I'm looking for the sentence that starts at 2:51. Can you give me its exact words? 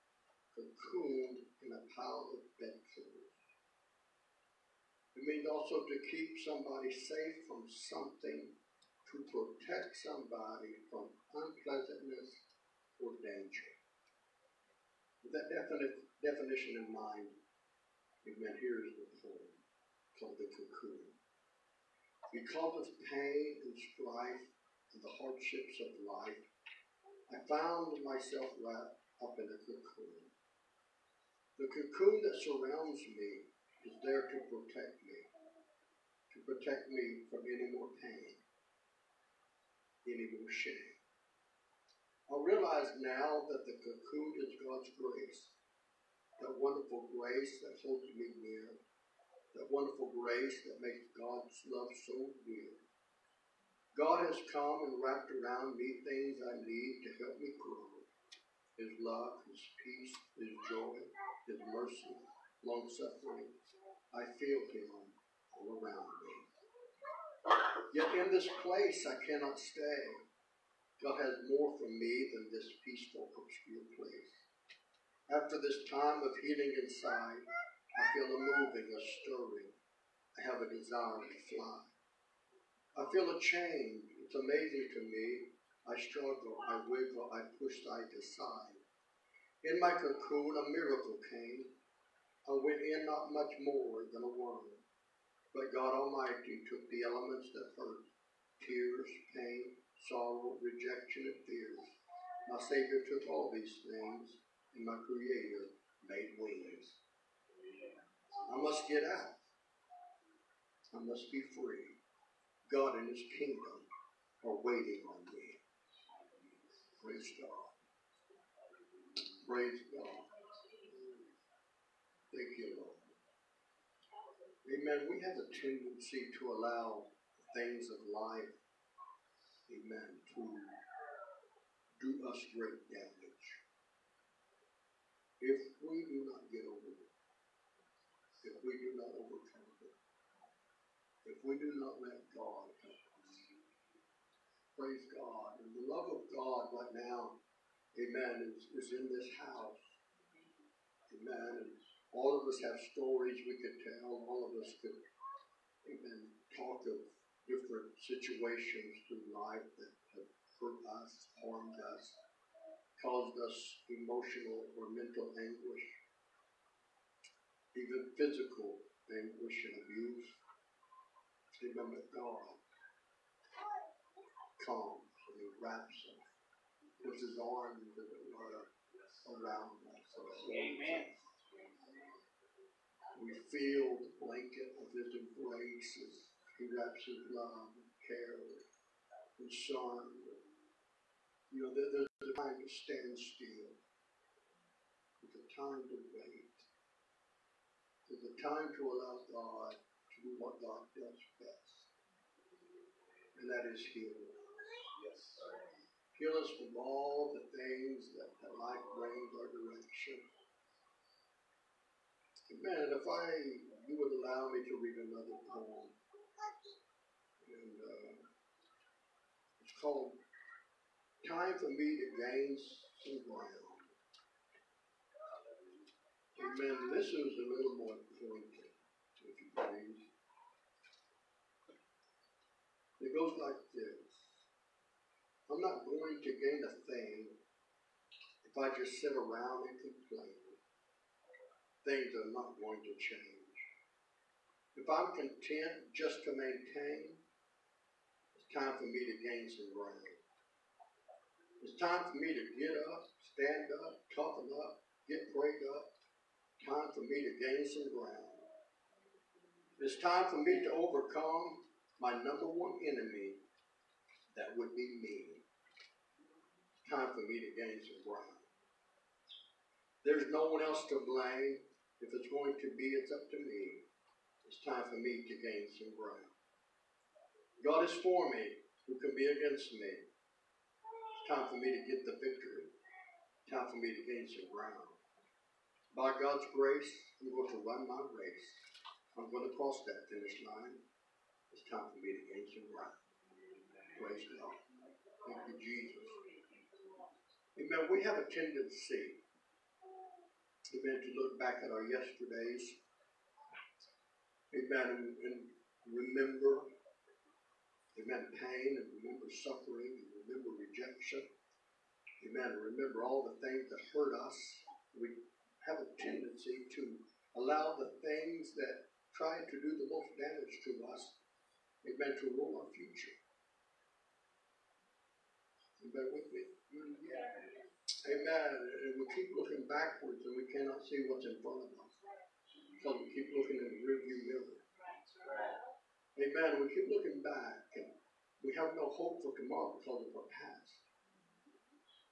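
Remember, God comes and He wraps us, puts His arms around us.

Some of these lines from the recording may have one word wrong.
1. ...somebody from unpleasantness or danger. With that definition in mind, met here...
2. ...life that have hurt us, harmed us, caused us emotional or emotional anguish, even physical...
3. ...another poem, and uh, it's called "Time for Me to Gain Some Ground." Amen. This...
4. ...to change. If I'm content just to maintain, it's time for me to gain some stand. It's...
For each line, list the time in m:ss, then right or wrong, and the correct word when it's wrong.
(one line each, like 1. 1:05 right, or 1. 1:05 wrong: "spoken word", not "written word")
1. 0:10 right
2. 2:39 wrong: "mental", not "emotional"
3. 3:35 right
4. 4:02 wrong: "ground", not "stand".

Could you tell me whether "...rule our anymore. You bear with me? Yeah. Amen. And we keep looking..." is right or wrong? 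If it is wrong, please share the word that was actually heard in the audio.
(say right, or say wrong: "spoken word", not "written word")
wrong: "future", not "anymore".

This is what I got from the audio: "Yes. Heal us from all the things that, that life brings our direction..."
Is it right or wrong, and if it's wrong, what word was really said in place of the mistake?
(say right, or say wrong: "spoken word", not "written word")
right.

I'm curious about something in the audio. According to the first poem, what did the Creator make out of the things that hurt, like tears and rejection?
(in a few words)
Wings.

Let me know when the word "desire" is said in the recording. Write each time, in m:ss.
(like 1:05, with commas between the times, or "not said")
1:20.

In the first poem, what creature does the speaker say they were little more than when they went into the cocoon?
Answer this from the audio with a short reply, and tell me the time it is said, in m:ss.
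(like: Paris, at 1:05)
A worm, at 1:34.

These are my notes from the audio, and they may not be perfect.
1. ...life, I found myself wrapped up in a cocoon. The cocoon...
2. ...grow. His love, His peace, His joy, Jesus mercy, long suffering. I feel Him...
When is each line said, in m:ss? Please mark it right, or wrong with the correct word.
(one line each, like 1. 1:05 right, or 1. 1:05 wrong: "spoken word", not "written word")
1. 0:26 right
2. 0:57 wrong: "His", not "Jesus".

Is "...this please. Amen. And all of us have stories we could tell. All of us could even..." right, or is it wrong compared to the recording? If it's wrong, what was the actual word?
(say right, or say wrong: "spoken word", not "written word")
wrong: "house", not "please".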